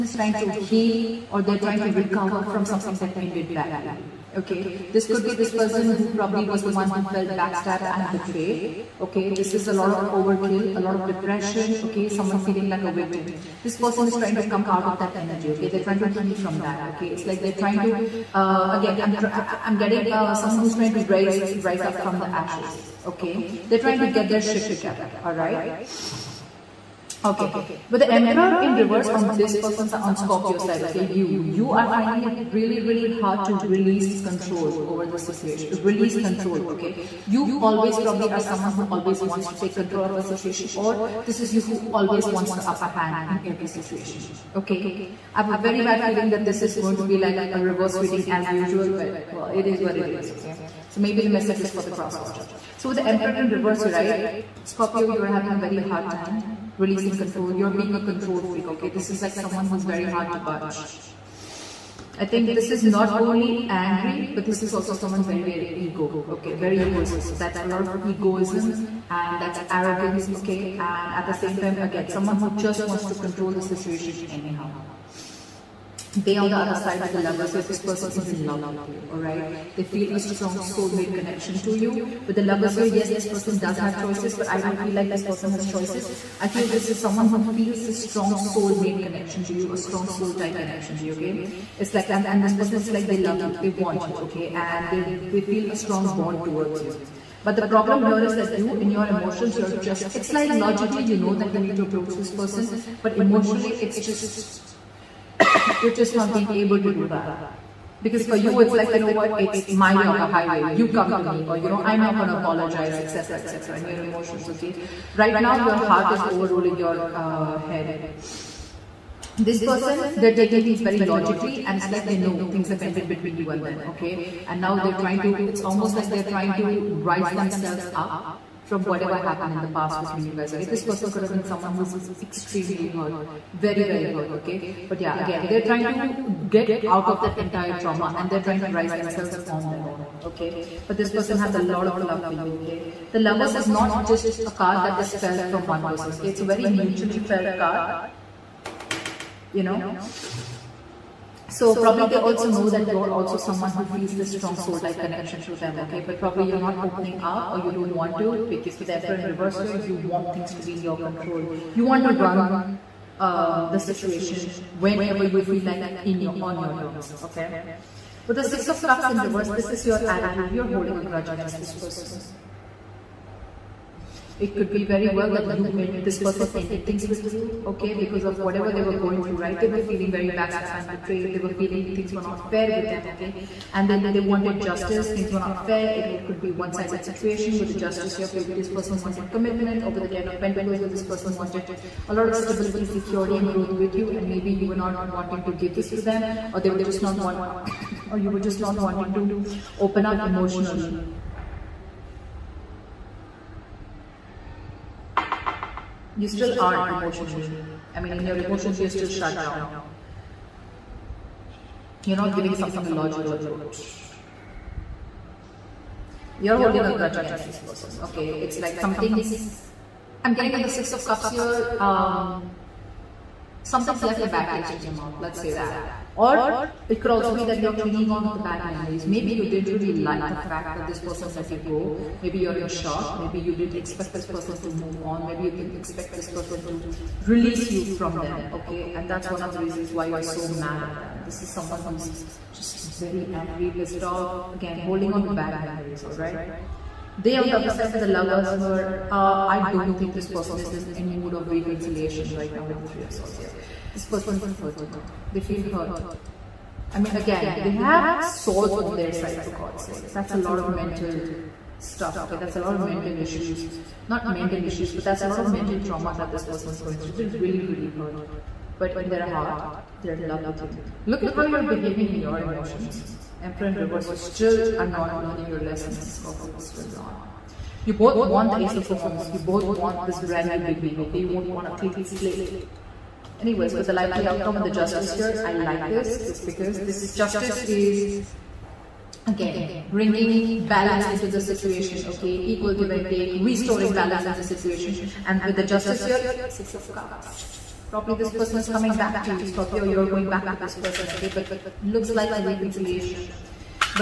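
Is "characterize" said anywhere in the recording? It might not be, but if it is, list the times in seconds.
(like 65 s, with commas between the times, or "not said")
not said.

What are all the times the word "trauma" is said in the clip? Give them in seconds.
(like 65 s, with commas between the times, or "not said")
137 s, 265 s.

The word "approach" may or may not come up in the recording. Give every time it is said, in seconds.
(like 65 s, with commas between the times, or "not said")
101 s, 213 s.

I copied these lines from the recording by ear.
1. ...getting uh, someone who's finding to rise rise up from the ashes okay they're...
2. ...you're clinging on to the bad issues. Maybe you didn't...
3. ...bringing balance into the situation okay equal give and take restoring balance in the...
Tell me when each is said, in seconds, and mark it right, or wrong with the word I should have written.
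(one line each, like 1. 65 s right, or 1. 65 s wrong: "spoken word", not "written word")
1. 19 s wrong: "trying", not "finding"
2. 227 s wrong: "memories", not "issues"
3. 289 s right.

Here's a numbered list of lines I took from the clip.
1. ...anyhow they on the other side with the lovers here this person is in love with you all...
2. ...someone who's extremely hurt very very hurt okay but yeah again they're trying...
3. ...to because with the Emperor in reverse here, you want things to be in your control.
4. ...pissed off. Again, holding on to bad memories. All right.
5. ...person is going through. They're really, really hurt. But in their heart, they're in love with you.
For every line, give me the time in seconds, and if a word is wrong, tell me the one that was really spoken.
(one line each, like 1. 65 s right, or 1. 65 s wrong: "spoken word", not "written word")
1. 74 s right
2. 131 s right
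3. 158 s right
4. 243 s right
5. 266 s right.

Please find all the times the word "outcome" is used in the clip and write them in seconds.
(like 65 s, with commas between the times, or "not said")
284 s.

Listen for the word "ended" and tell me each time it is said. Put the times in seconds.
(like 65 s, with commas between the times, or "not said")
3 s, 122 s, 176 s.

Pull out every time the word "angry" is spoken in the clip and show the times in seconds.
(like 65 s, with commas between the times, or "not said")
63 s, 243 s.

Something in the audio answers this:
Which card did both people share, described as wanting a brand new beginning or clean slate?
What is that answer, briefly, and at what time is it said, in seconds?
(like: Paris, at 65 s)
Ace of Wands, at 278 s.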